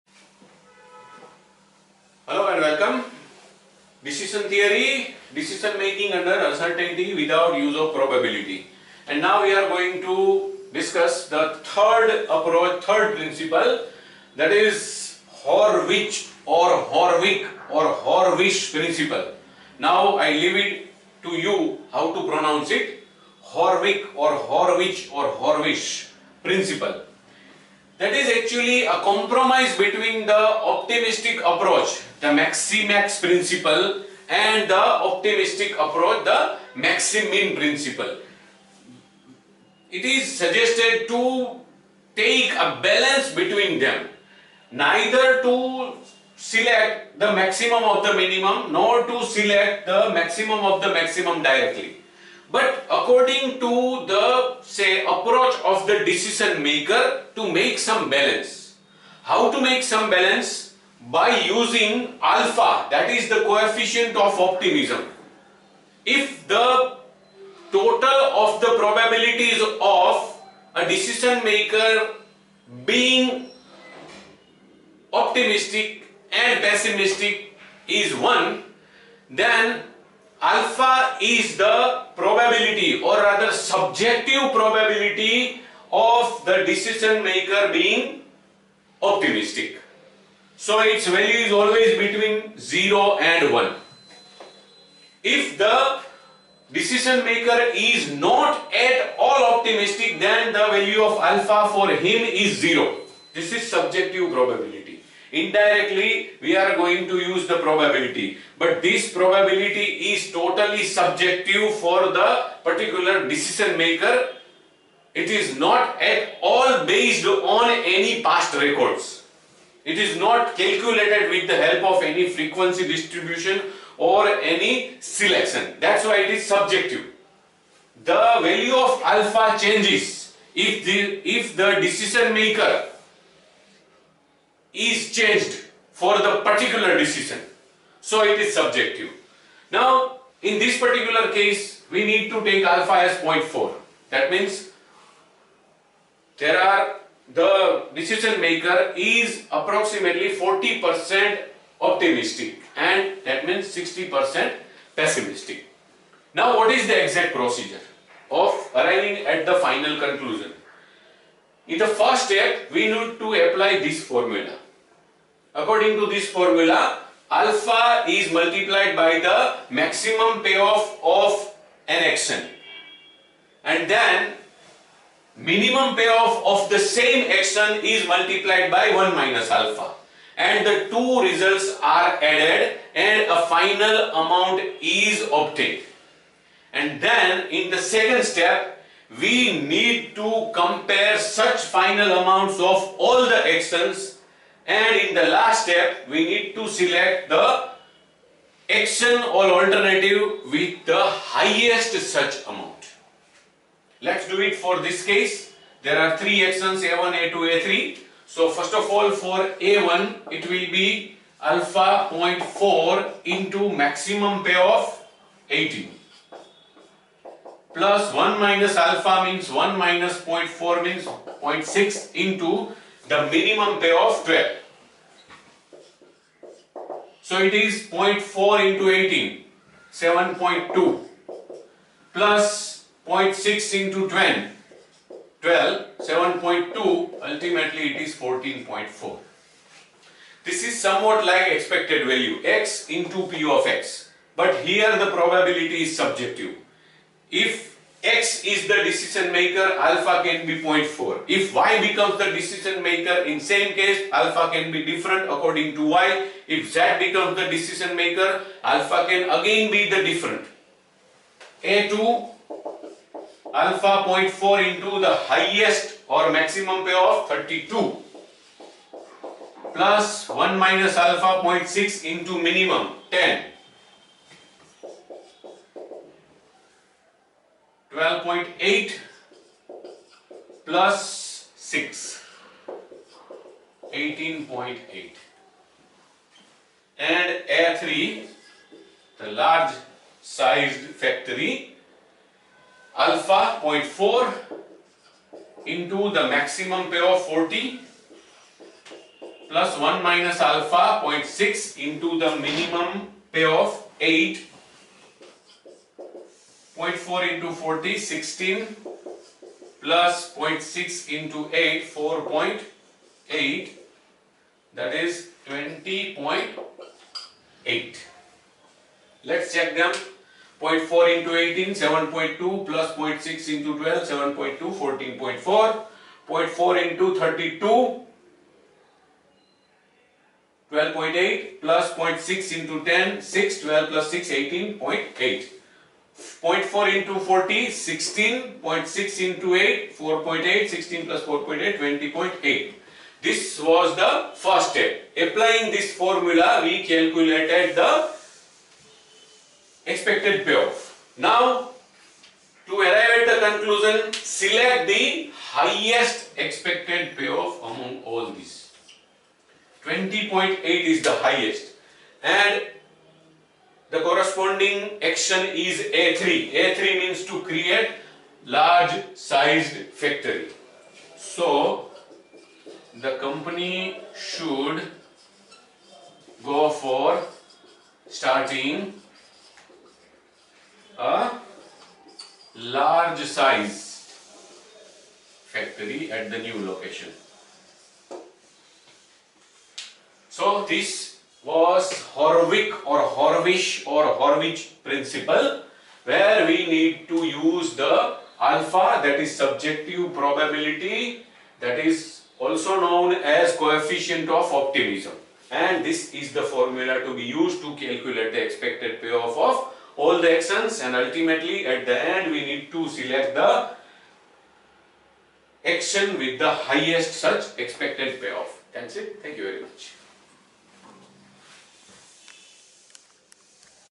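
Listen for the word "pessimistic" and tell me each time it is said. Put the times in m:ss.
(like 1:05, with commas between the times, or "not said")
1:16, 2:34.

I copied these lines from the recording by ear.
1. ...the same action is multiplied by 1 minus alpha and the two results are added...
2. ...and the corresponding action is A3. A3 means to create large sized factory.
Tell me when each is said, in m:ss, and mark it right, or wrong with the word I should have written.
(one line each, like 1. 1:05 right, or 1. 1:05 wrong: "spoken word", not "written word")
1. 2:56 right
2. 6:02 right.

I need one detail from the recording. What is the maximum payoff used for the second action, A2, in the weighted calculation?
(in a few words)
32.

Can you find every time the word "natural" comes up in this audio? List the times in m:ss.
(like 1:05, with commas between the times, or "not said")
not said.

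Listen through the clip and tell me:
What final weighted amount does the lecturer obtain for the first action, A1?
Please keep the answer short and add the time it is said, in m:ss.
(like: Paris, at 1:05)
14.4, at 3:58.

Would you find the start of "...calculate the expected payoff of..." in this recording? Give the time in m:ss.
6:47.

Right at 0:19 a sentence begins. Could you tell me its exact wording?
Now I leave it to you how to pronounce it.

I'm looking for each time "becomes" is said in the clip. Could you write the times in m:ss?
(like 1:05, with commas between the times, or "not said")
4:11, 4:16.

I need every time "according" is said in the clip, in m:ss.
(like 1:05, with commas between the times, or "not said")
0:52, 2:45, 4:15.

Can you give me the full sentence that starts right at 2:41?
In the first step we need to apply this formula.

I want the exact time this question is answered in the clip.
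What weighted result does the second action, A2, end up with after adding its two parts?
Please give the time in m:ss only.
4:43.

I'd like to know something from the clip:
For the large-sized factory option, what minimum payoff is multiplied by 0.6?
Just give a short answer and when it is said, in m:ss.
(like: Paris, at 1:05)
8, at 5:02.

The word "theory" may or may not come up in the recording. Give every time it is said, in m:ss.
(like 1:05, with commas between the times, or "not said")
0:04.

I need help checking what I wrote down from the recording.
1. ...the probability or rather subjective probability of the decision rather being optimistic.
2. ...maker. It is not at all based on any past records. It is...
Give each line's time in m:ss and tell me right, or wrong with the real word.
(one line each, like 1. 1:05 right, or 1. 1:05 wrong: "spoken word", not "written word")
1. 1:21 wrong: "maker", not "rather"
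2. 1:53 right.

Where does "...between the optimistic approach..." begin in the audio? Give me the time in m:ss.
0:29.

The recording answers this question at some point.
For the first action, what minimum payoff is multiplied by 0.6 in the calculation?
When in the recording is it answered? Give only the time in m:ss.
3:43.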